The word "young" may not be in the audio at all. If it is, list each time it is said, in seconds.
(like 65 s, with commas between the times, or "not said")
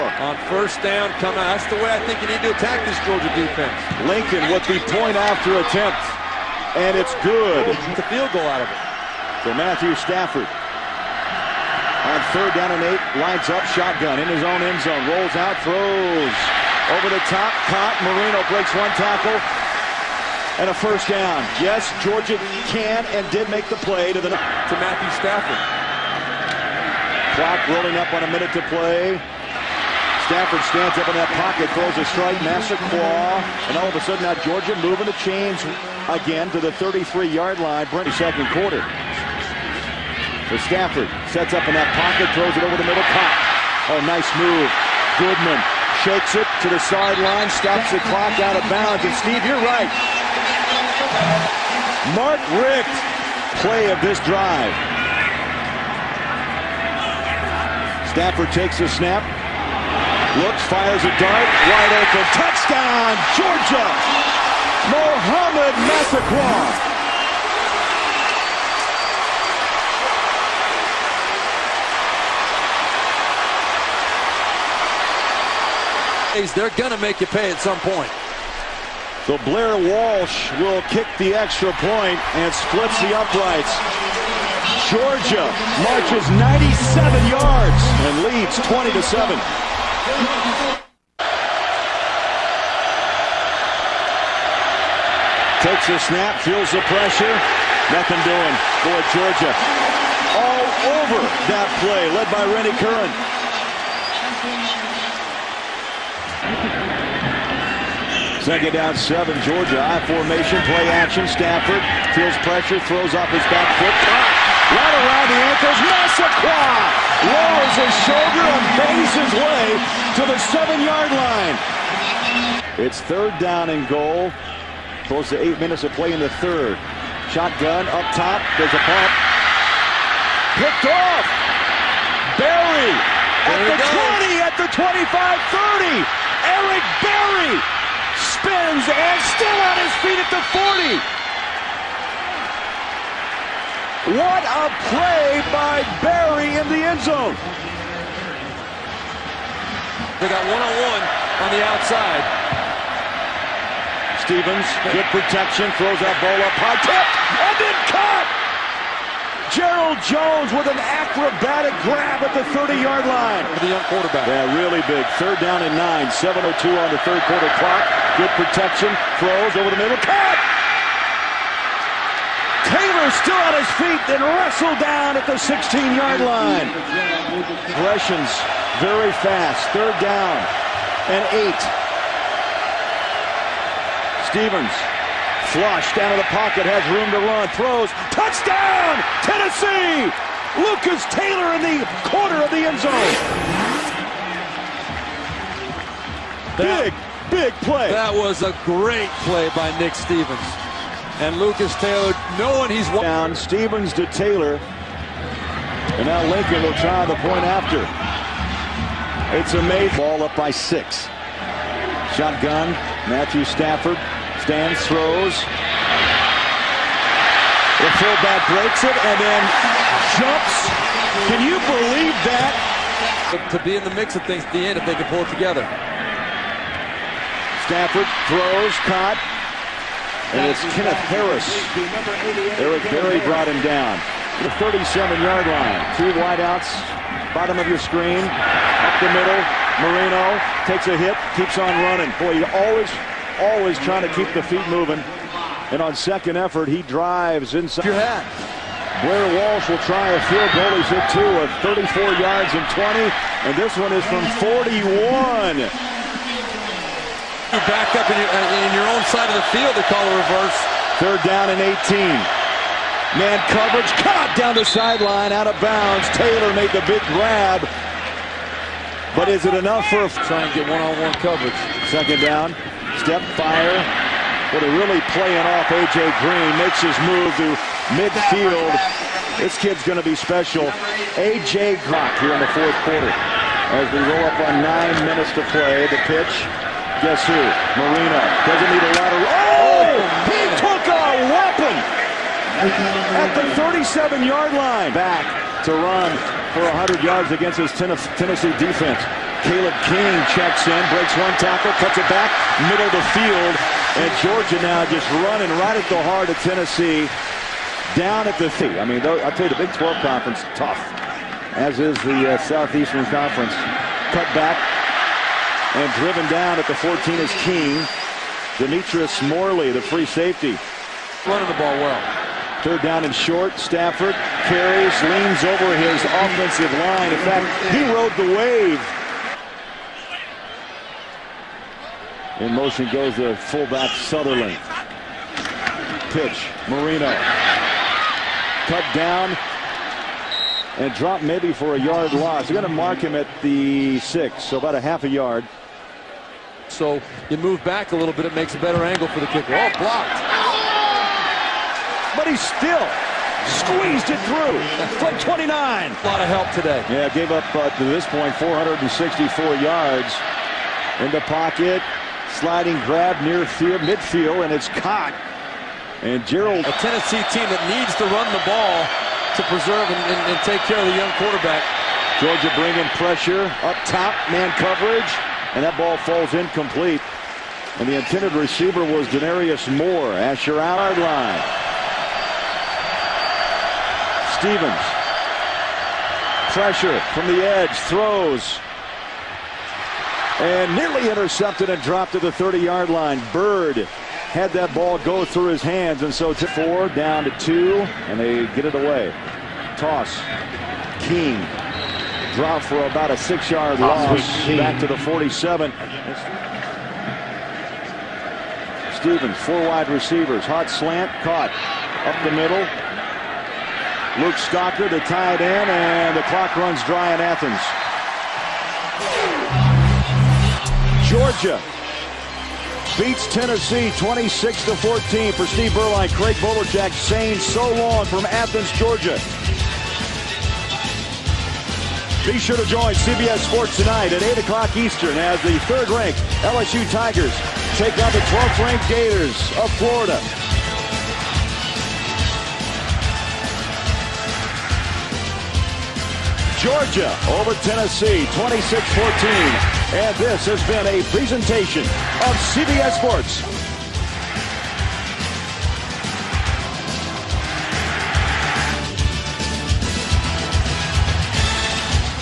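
163 s, 370 s.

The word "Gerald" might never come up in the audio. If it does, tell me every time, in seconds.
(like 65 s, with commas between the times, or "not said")
159 s, 366 s.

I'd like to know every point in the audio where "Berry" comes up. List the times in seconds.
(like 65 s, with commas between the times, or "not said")
132 s, 137 s, 146 s, 232 s.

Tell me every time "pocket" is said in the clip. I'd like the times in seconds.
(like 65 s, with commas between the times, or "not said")
31 s, 41 s, 186 s, 361 s.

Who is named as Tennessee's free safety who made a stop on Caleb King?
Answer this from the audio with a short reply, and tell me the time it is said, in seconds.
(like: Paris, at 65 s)
Demetrice Morley, at 318 s.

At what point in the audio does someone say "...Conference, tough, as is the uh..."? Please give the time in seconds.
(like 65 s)
309 s.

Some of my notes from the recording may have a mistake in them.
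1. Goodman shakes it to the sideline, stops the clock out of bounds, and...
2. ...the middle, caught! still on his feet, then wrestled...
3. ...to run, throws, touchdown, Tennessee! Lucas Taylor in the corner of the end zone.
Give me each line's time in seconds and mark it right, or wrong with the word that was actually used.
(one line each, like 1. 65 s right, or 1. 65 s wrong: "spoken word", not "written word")
1. 45 s right
2. 169 s right
3. 187 s right.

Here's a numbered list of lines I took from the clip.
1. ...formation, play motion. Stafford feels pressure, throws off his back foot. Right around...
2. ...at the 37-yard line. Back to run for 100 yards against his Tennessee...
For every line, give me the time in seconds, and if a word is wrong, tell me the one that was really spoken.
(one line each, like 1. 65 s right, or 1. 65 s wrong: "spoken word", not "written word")
1. 110 s wrong: "action", not "motion"
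2. 292 s right.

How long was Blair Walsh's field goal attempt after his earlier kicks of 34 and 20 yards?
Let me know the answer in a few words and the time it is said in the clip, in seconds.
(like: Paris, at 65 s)
41 yards, at 254 s.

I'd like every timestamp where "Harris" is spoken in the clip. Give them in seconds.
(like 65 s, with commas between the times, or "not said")
231 s.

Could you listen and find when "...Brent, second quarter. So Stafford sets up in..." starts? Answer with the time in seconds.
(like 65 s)
37 s.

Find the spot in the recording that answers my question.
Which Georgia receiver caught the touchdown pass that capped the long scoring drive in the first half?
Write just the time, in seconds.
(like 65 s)
64 s.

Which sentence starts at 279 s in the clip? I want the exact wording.
This kid's going to be special.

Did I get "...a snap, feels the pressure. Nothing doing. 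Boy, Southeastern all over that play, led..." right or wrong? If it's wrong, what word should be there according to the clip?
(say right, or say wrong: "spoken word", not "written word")
wrong: "Georgia", not "Southeastern".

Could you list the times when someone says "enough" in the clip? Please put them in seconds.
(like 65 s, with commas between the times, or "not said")
269 s.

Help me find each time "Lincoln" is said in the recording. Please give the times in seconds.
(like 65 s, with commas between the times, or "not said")
4 s, 206 s.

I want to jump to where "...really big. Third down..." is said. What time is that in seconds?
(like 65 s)
164 s.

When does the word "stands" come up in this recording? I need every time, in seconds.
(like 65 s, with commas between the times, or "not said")
30 s, 214 s.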